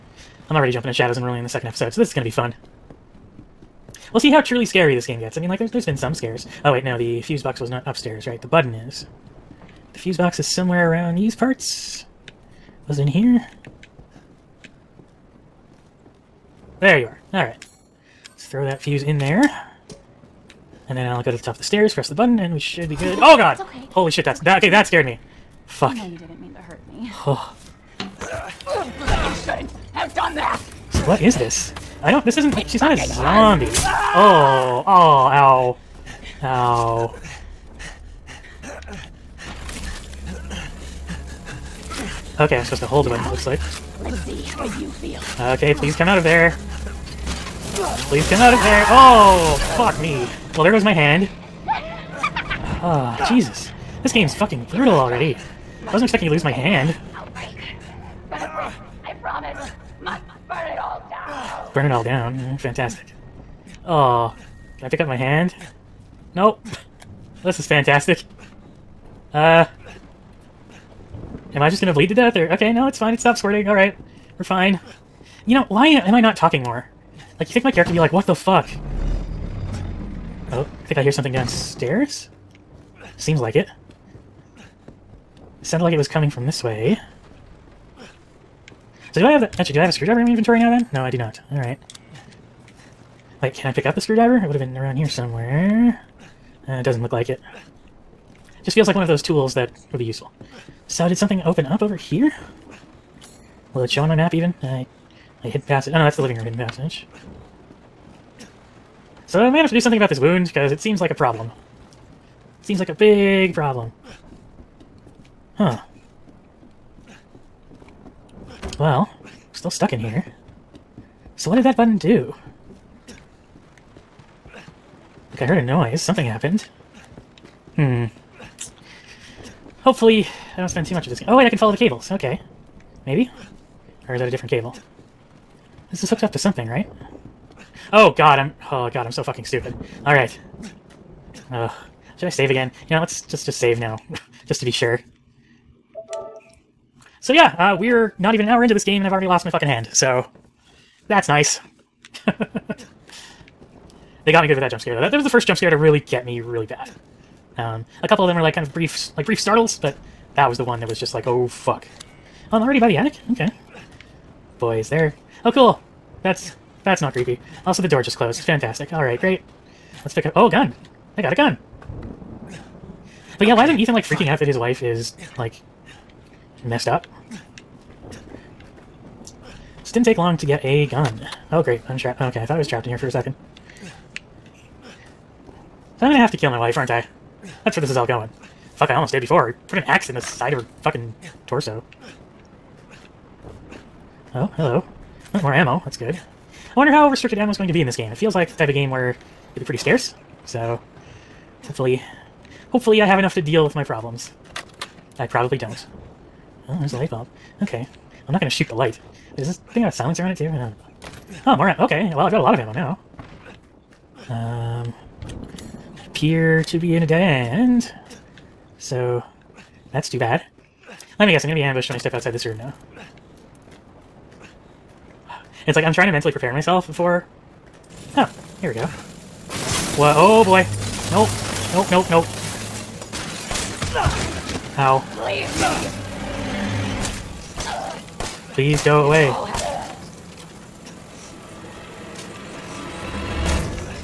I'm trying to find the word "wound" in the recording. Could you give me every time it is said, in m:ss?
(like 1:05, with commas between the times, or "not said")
1:50.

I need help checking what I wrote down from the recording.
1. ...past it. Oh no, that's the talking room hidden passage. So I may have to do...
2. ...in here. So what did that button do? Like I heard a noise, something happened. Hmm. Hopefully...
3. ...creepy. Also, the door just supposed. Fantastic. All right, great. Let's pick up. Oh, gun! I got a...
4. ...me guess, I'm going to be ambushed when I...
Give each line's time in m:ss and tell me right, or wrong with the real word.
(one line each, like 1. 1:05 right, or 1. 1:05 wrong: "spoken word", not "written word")
1. 1:45 wrong: "living", not "talking"
2. 1:59 right
3. 2:47 wrong: "closed", not "supposed"
4. 3:41 right.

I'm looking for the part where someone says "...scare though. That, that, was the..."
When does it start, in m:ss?
2:34.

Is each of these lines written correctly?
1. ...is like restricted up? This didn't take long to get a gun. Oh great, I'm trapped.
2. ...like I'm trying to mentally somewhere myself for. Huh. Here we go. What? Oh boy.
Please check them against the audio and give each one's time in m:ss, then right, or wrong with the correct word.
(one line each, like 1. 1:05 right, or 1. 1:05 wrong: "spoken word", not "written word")
1. 2:54 wrong: "messed", not "restricted"
2. 3:45 wrong: "prepare", not "somewhere".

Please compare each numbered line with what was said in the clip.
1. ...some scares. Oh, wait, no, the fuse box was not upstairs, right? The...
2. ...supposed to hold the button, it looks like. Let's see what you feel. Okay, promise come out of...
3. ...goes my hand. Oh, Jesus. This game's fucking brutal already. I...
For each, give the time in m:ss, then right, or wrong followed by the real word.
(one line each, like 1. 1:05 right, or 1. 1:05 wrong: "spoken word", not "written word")
1. 0:05 right
2. 0:42 wrong: "please", not "promise"
3. 0:50 right.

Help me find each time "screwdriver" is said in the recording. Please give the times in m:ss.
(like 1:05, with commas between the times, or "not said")
1:29, 1:34.